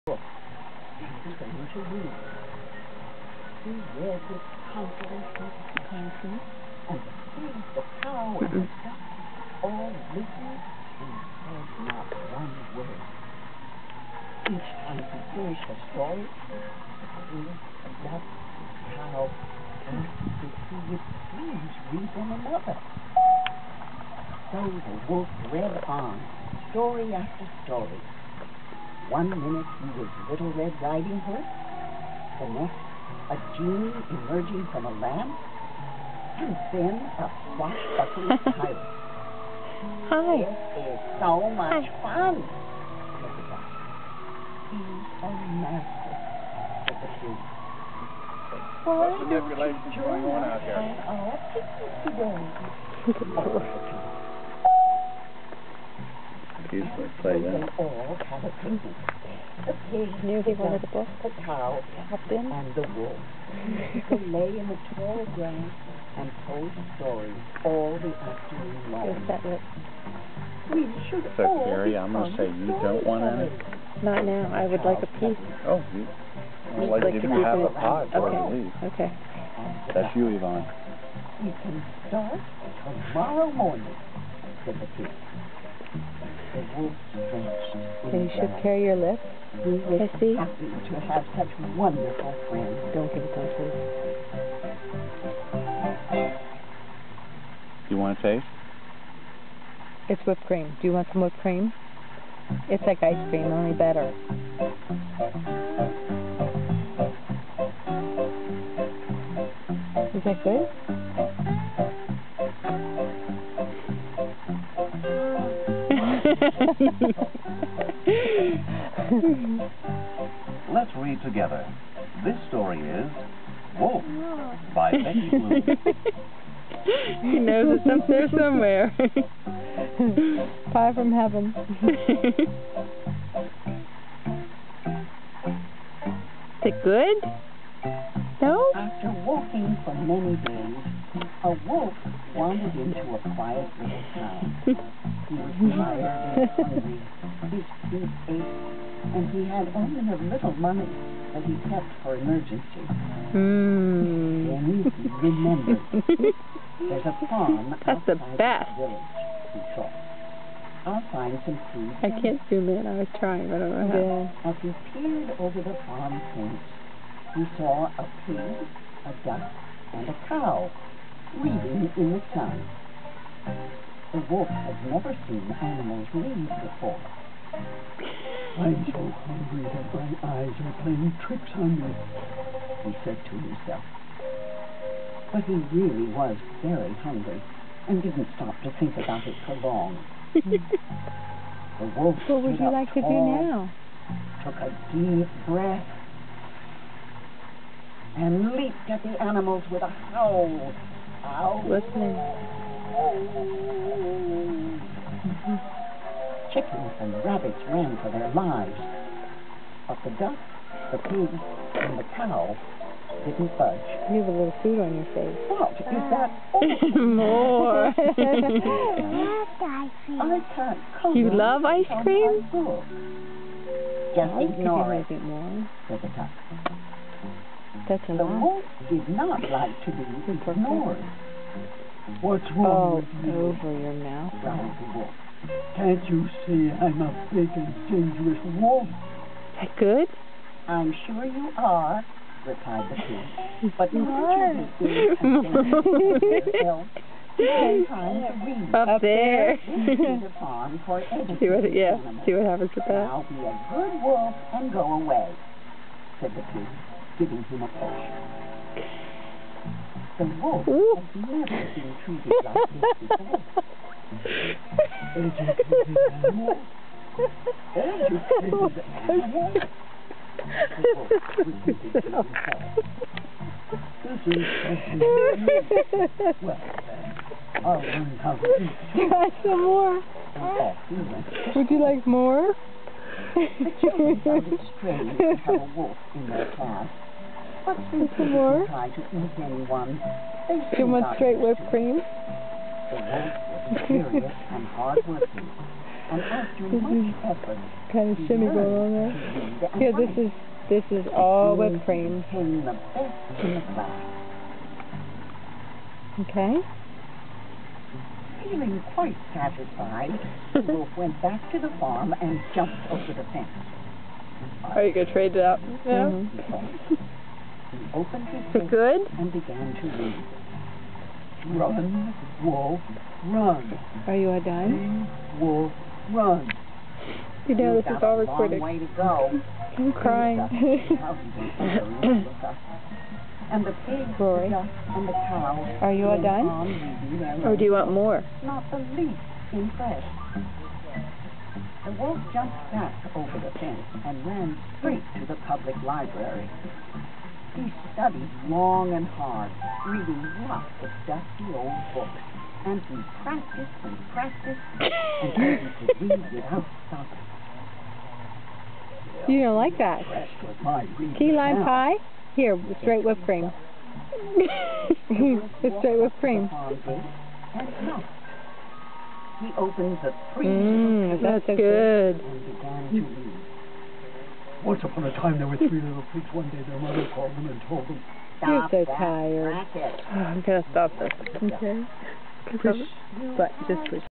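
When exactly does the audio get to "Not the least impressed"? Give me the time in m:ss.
5:38.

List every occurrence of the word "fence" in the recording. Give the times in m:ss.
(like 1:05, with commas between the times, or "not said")
2:46, 5:13, 5:43.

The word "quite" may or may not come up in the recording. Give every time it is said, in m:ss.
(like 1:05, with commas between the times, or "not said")
5:08.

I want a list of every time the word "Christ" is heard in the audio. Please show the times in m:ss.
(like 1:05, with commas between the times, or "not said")
not said.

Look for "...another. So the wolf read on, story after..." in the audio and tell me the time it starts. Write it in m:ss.
0:22.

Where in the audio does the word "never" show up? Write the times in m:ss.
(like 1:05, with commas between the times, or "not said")
2:54, 4:21.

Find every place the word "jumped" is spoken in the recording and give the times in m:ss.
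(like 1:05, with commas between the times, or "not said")
5:12, 5:42.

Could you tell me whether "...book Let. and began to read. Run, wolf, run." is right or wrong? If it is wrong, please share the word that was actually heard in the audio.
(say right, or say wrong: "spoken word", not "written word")
wrong: "Good", not "Let".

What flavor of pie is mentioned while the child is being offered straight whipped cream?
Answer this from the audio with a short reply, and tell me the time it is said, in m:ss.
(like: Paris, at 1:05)
key lime, at 6:01.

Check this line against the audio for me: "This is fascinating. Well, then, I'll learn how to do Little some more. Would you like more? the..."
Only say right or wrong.
wrong.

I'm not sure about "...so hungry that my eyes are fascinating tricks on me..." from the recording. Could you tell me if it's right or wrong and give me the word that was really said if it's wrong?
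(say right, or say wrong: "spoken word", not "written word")
wrong: "playing", not "fascinating".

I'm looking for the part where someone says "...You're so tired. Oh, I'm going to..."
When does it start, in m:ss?
6:18.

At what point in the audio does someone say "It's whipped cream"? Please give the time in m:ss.
1:40.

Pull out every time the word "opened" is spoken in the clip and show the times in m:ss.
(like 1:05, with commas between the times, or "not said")
5:17, 6:09.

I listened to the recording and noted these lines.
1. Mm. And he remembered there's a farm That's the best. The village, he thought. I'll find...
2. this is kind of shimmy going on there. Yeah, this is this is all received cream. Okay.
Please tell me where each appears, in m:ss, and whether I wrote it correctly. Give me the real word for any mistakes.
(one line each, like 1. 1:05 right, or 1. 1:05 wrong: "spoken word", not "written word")
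1. 2:33 right
2. 4:52 wrong: "whipped", not "received".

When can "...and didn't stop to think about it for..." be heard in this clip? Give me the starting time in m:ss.
3:07.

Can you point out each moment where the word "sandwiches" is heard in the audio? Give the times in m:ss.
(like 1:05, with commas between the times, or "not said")
not said.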